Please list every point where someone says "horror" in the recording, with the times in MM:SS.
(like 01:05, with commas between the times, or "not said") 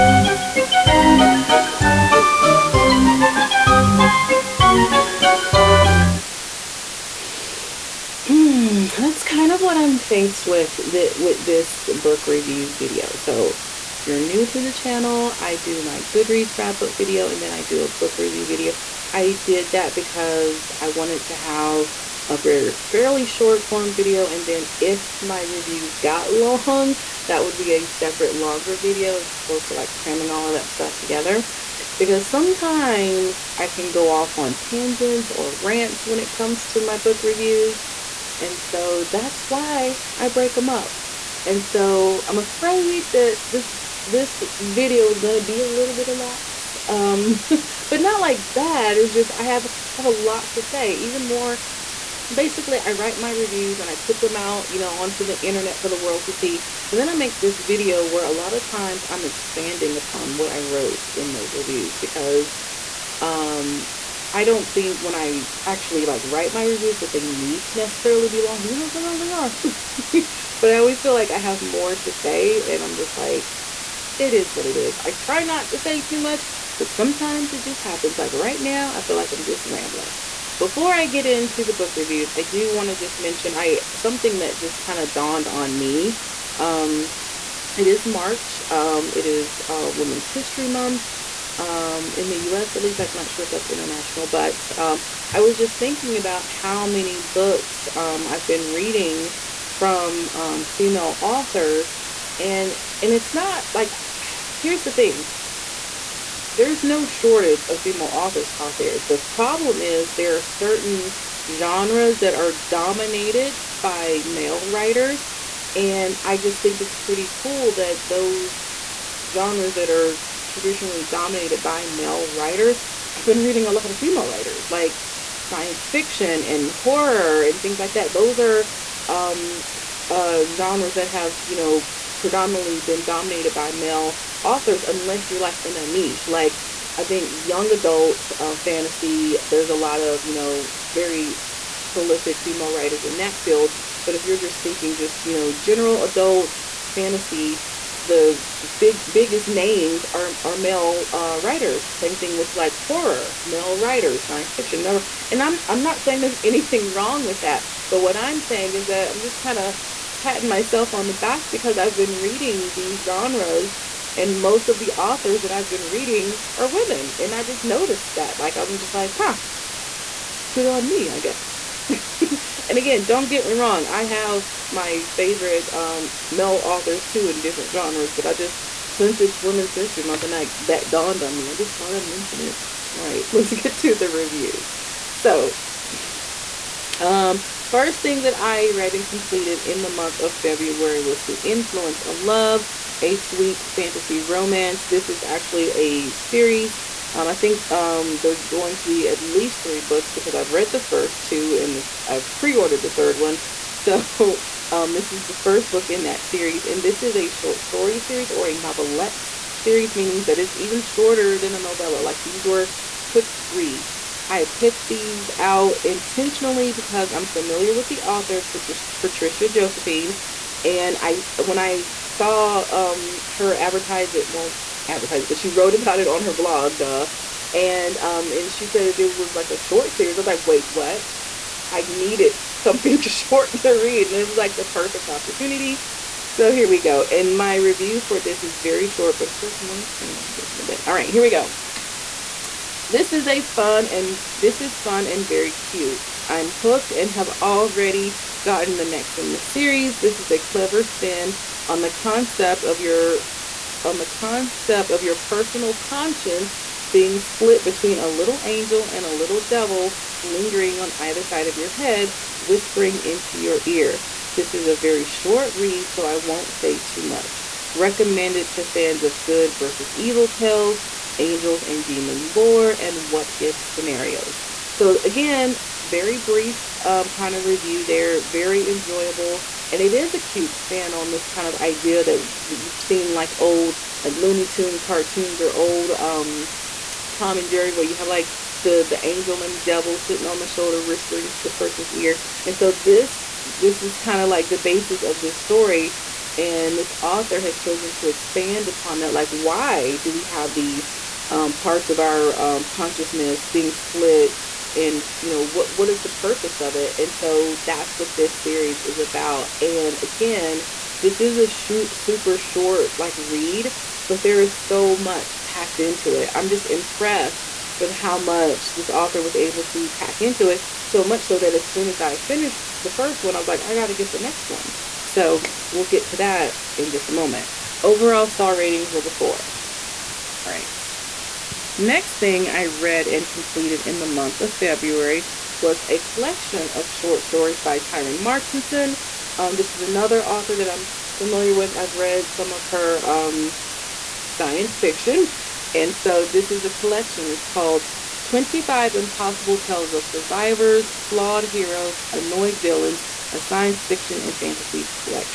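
02:06, 02:32.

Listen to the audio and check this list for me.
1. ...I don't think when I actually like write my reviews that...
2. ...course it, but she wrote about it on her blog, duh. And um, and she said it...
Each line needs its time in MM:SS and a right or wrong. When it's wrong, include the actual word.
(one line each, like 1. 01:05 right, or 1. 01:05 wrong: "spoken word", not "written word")
1. 01:04 right
2. 03:44 wrong: "advertise", not "course".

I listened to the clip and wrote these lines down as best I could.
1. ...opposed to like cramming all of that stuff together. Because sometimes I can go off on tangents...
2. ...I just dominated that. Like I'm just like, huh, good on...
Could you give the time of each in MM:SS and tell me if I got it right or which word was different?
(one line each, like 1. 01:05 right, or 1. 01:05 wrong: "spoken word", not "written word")
1. 00:29 right
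2. 02:47 wrong: "noticed", not "dominated".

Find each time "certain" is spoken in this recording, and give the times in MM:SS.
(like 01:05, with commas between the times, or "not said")
01:50.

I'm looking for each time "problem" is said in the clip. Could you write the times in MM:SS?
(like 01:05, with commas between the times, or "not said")
01:49.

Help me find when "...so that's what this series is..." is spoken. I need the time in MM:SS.
05:07.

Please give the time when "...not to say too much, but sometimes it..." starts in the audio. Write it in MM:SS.
01:15.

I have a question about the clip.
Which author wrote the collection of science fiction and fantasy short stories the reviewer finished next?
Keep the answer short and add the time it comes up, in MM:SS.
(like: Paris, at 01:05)
Tyrean Martinson, at 05:37.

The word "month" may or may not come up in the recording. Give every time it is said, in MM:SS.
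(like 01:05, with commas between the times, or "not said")
01:30, 03:00, 03:09, 05:34.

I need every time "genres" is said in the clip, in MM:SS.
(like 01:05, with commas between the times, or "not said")
01:51, 01:59, 02:10, 02:43, 02:57.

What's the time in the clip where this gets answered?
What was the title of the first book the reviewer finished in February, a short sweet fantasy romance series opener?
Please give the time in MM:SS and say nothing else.
03:11.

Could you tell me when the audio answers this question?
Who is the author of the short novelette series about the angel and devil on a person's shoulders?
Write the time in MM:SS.
03:38.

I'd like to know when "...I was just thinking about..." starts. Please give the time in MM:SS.
01:35.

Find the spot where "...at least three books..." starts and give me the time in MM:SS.
03:19.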